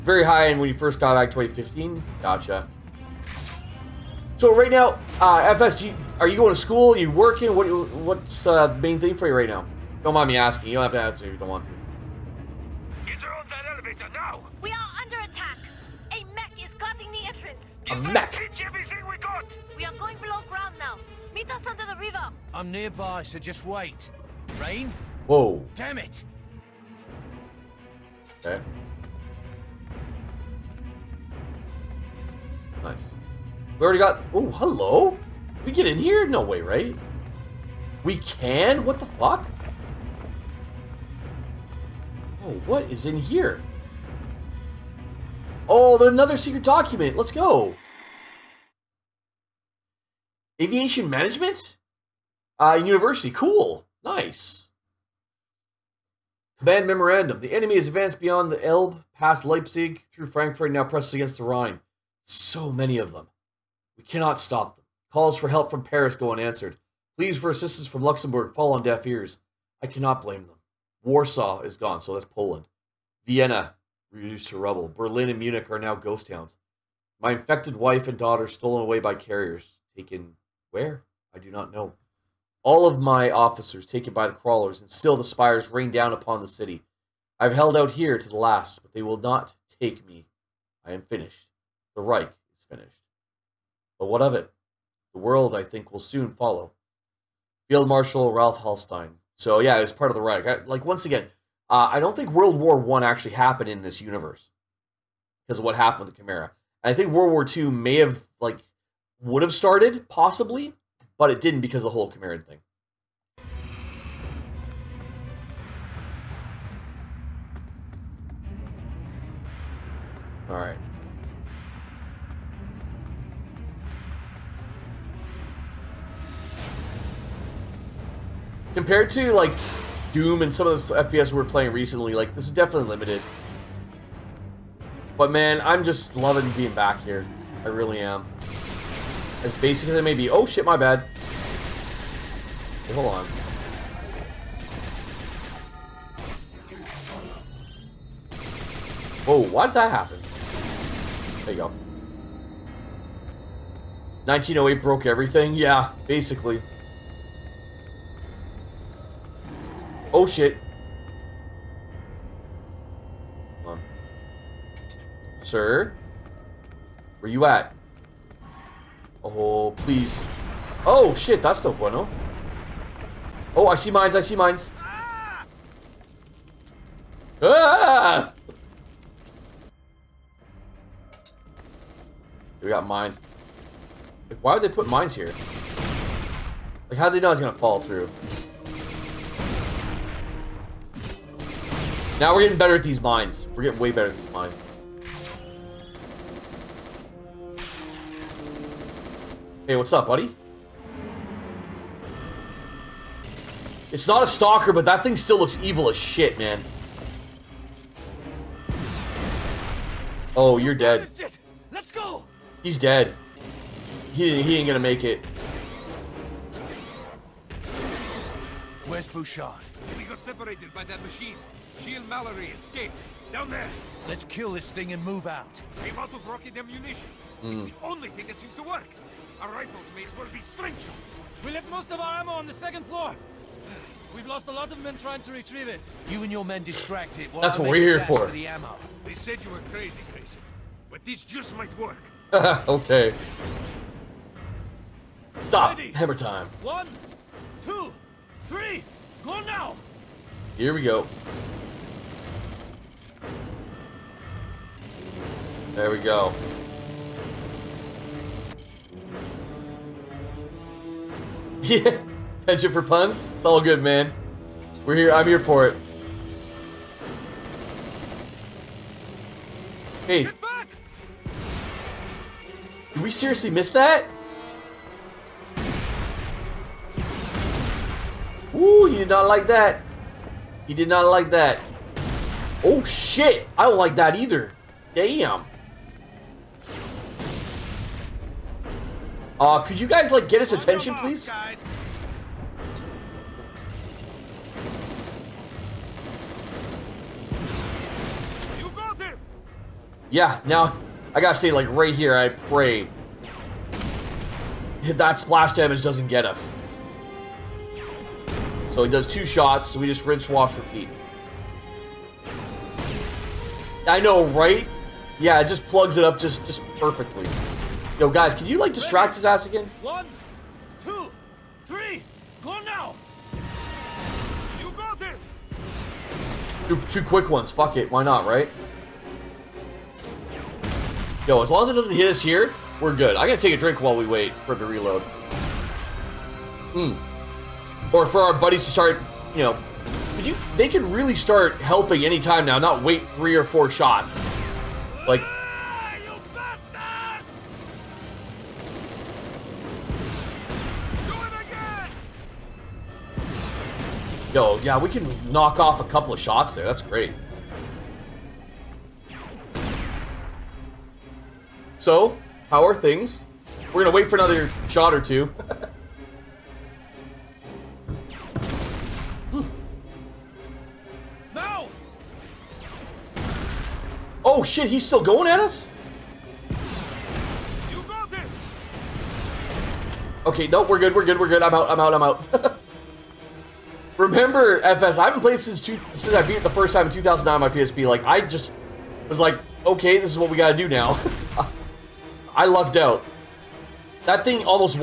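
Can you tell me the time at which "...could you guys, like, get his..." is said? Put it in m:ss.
4:49.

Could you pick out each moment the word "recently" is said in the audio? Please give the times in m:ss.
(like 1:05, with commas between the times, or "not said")
2:11.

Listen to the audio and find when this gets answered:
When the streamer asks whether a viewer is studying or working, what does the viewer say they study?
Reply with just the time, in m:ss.
0:50.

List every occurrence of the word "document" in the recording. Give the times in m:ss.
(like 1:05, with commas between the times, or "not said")
0:46.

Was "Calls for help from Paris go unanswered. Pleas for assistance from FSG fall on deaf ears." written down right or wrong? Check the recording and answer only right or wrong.
wrong.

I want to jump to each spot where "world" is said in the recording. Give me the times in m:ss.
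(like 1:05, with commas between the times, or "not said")
1:35, 1:42, 1:47.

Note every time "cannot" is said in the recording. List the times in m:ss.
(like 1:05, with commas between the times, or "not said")
1:04, 1:09.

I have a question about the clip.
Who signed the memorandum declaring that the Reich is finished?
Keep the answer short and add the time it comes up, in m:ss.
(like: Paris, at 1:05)
Field Marshal Ralph Hallstein, at 1:37.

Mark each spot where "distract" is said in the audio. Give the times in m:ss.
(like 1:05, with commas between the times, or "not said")
3:56, 5:18.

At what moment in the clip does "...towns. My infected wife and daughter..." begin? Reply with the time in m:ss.
1:16.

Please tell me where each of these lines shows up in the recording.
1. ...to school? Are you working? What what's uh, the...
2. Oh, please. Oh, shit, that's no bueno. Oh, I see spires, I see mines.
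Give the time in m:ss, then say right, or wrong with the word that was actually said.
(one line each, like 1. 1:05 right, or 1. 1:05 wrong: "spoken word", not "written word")
1. 0:06 right
2. 2:49 wrong: "mines", not "spires".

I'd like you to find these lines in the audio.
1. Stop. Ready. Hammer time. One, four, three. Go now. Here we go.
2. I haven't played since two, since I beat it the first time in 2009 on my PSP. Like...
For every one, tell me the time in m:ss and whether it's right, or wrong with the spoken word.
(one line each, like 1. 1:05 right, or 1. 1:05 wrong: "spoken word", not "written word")
1. 4:05 wrong: "two", not "four"
2. 6:24 right.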